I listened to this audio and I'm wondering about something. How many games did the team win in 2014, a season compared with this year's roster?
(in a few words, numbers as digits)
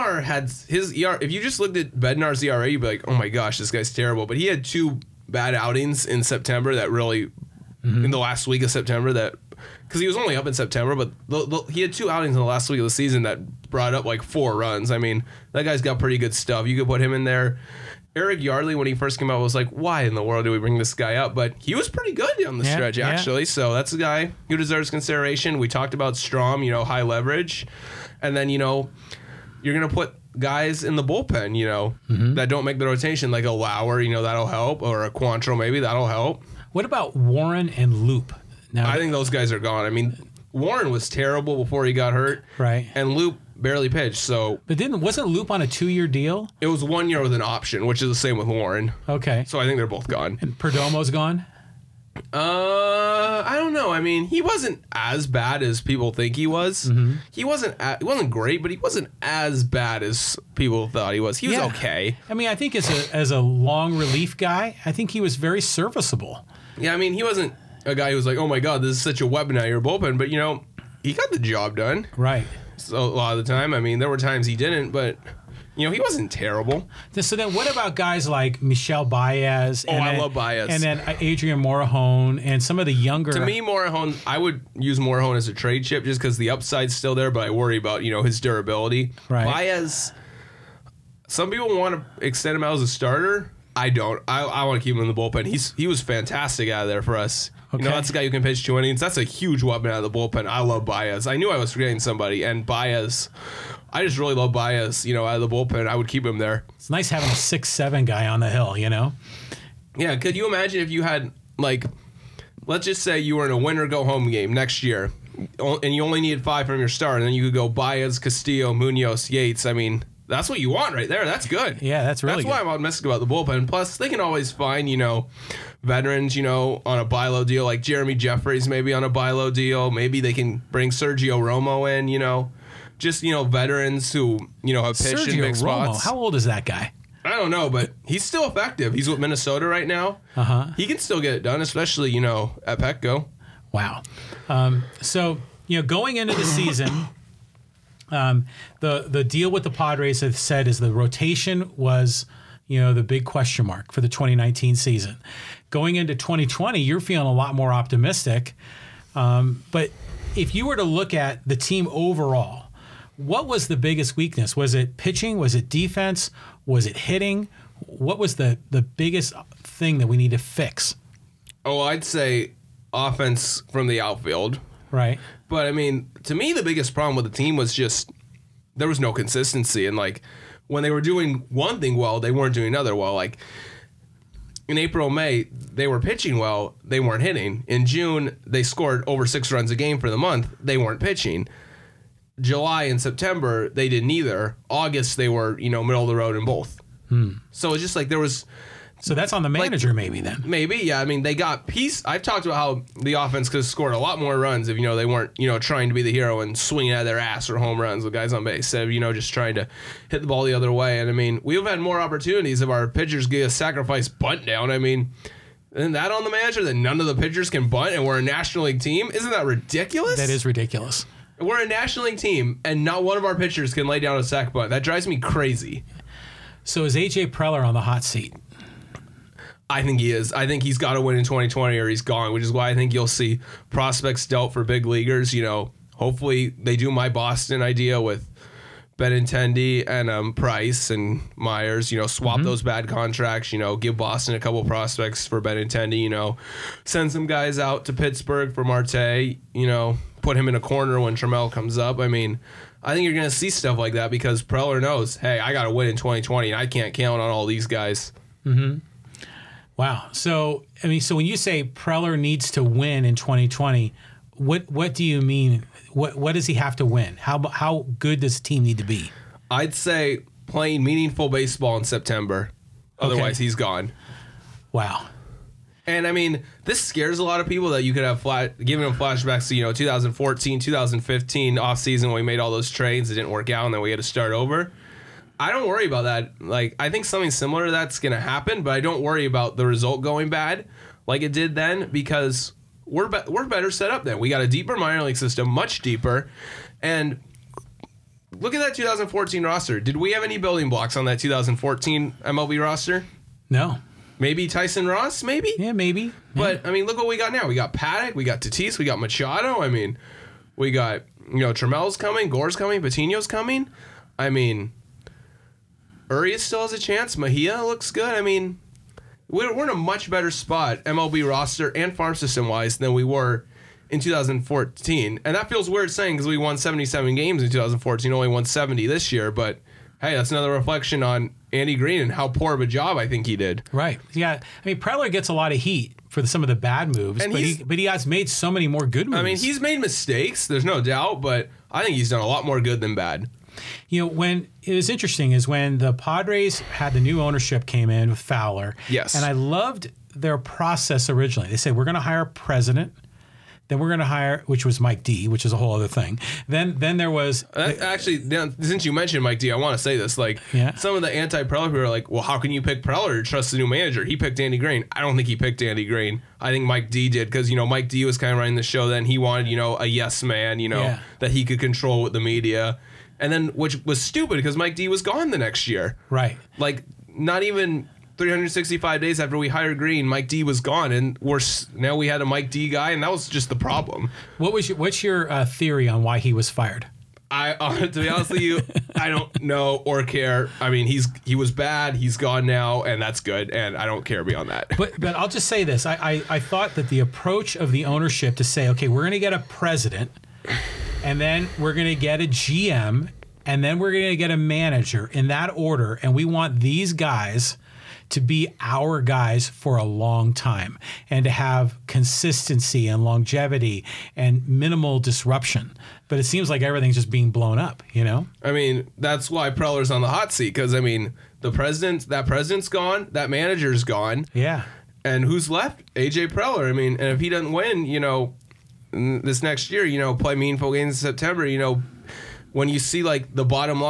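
77.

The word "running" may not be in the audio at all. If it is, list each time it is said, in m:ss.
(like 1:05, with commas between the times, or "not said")
6:08.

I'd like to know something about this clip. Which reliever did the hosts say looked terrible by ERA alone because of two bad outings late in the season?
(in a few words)
Bednar.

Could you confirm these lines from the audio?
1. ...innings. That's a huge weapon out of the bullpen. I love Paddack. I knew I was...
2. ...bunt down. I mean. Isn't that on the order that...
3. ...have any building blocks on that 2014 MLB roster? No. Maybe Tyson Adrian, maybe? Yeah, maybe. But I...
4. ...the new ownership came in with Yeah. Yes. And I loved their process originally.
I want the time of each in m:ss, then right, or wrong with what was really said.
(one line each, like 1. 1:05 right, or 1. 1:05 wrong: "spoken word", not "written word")
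1. 1:38 wrong: "Baez", not "Paddack"
2. 3:34 wrong: "manager", not "order"
3. 5:00 wrong: "Ross", not "Adrian"
4. 5:46 wrong: "Fowler", not "Yeah".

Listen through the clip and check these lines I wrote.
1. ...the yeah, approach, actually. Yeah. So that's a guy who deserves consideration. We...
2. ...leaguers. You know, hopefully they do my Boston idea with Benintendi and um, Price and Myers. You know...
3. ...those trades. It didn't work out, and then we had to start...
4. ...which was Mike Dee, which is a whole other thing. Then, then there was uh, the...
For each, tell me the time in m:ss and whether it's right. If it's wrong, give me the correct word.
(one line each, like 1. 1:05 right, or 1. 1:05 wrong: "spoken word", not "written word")
1. 0:22 wrong: "stretch", not "approach"
2. 3:54 right
3. 4:42 right
4. 5:54 right.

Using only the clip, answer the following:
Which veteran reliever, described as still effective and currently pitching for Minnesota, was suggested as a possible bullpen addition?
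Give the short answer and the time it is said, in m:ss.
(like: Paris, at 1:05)
Sergio Romo, at 2:10.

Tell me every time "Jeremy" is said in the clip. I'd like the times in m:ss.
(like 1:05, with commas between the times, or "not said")
2:07.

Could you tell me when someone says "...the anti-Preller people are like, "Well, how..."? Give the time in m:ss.
6:01.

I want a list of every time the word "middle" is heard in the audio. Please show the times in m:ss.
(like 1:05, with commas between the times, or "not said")
3:15.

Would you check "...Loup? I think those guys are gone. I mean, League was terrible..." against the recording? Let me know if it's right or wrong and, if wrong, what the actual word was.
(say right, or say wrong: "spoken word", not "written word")
wrong: "Warren", not "League".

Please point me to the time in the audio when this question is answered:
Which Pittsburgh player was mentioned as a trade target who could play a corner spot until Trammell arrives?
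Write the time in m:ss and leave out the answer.
4:08.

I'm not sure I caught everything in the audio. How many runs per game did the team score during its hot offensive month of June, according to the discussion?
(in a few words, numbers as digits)
over 6.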